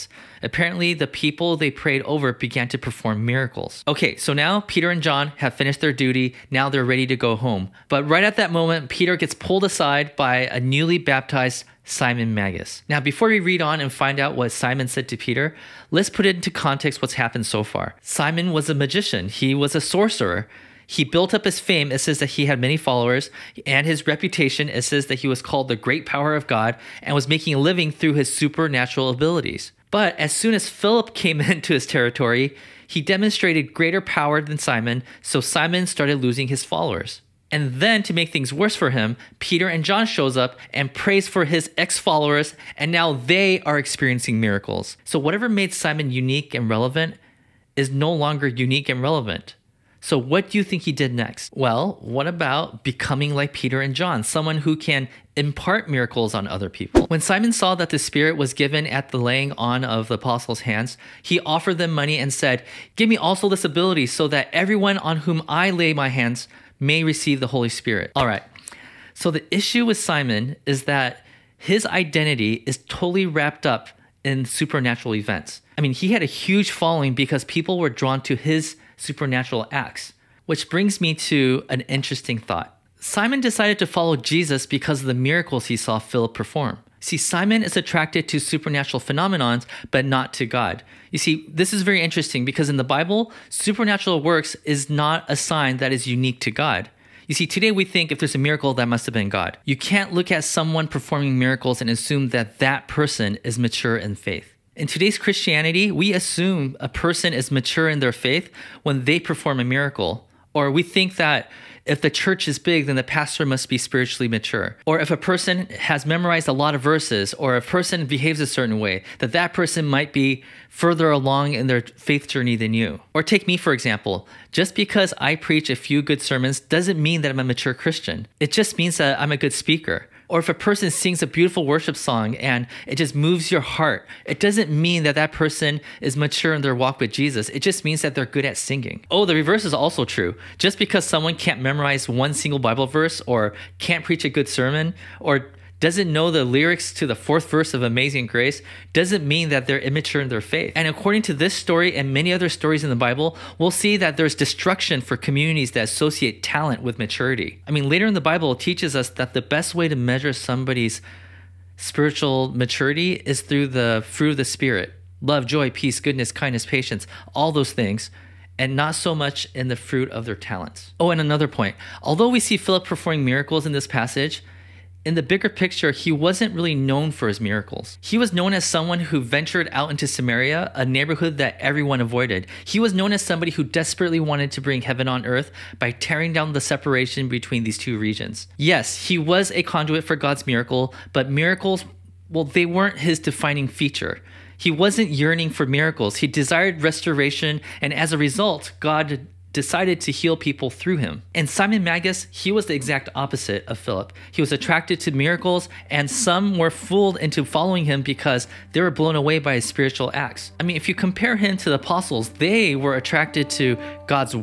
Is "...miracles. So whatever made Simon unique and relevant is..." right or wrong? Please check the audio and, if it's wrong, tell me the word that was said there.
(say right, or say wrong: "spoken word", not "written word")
right.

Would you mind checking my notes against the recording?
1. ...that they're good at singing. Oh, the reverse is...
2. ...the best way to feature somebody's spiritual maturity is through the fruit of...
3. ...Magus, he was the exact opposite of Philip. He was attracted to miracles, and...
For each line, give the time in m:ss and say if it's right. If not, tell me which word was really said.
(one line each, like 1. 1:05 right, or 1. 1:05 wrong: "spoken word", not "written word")
1. 2:18 right
2. 2:39 wrong: "measure", not "feature"
3. 3:21 right.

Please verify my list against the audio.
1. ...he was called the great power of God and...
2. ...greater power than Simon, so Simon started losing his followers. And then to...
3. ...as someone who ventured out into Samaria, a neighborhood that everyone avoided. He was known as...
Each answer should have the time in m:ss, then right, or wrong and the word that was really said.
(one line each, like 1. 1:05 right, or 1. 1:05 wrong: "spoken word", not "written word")
1. 0:25 right
2. 0:33 right
3. 2:58 right.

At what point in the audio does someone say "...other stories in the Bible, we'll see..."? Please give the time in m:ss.
2:32.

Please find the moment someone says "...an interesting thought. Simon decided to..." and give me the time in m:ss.
1:21.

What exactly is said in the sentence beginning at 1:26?
See, Simon is attracted to supernatural phenomenons, but not to God.